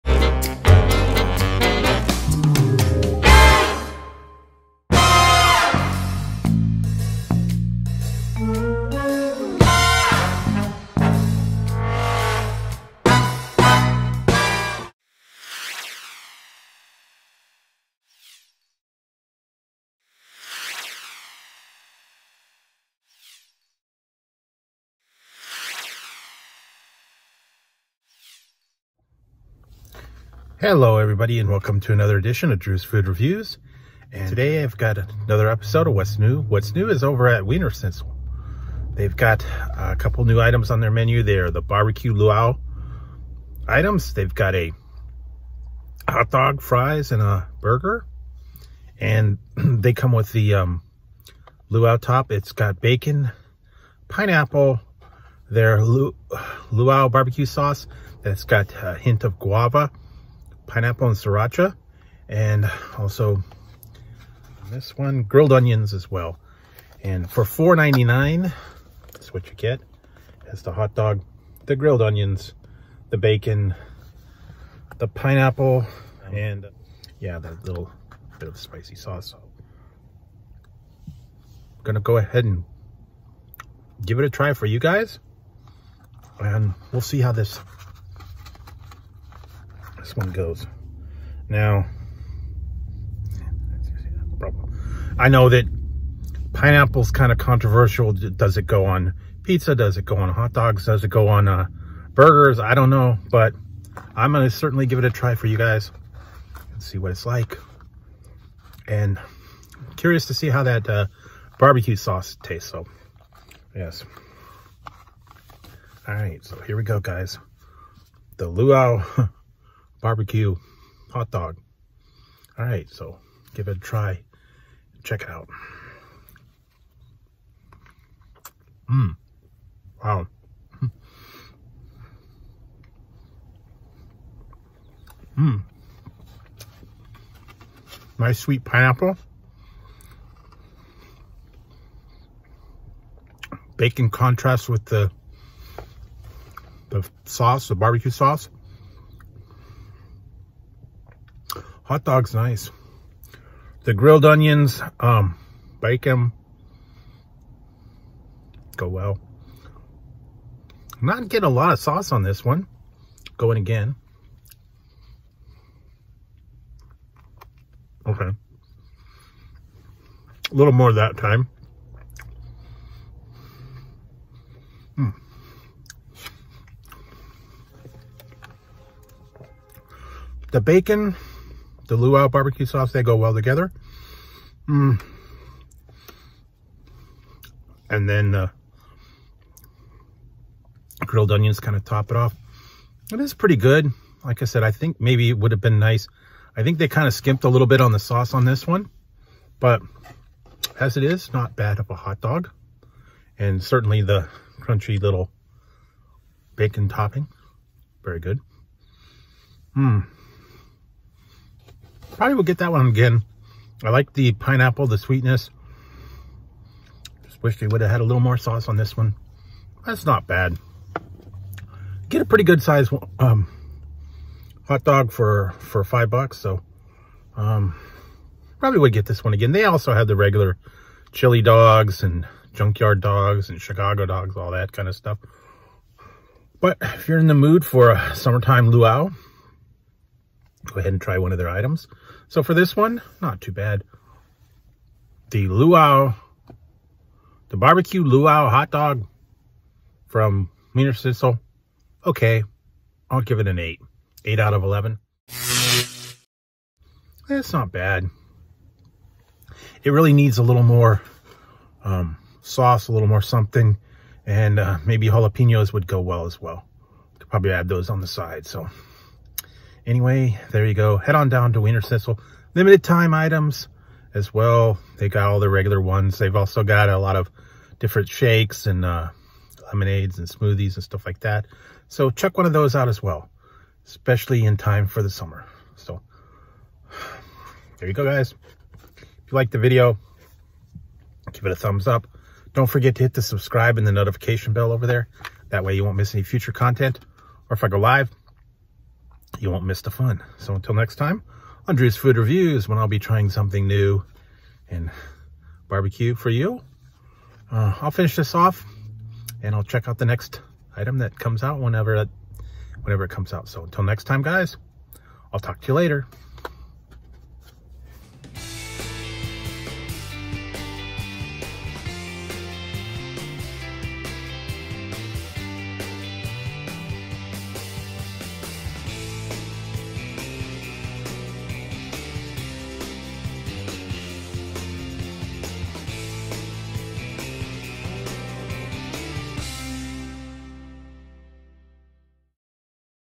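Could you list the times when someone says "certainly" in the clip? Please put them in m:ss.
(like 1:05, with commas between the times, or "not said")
1:44, 3:23.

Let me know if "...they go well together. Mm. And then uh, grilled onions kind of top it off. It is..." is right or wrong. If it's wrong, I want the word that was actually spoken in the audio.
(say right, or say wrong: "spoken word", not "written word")
right.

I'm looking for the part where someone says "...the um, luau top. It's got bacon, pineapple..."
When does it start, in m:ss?
0:50.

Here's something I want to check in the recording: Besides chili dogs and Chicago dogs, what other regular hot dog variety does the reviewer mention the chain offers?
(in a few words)
junkyard dogs.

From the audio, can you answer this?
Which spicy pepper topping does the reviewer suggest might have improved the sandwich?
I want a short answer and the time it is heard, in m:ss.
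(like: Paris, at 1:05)
jalapenos, at 4:25.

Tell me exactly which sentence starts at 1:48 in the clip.
And I'm curious to see how that uh, barbecue sauce tastes.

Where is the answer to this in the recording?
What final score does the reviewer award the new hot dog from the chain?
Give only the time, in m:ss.
4:14.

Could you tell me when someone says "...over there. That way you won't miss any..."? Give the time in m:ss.
4:54.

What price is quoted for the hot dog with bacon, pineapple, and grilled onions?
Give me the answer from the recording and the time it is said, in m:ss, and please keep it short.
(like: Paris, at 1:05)
$4.99, at 1:07.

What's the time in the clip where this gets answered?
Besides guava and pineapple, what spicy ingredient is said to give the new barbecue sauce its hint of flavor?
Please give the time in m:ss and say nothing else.
1:01.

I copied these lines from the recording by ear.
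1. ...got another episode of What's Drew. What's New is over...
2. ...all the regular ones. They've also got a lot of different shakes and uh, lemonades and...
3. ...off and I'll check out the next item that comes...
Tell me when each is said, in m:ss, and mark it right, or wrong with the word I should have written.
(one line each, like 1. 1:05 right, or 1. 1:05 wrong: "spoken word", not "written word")
1. 0:34 wrong: "New", not "Drew"
2. 4:35 right
3. 5:08 right.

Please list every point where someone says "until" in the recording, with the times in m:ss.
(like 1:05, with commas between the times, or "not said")
5:00, 5:13.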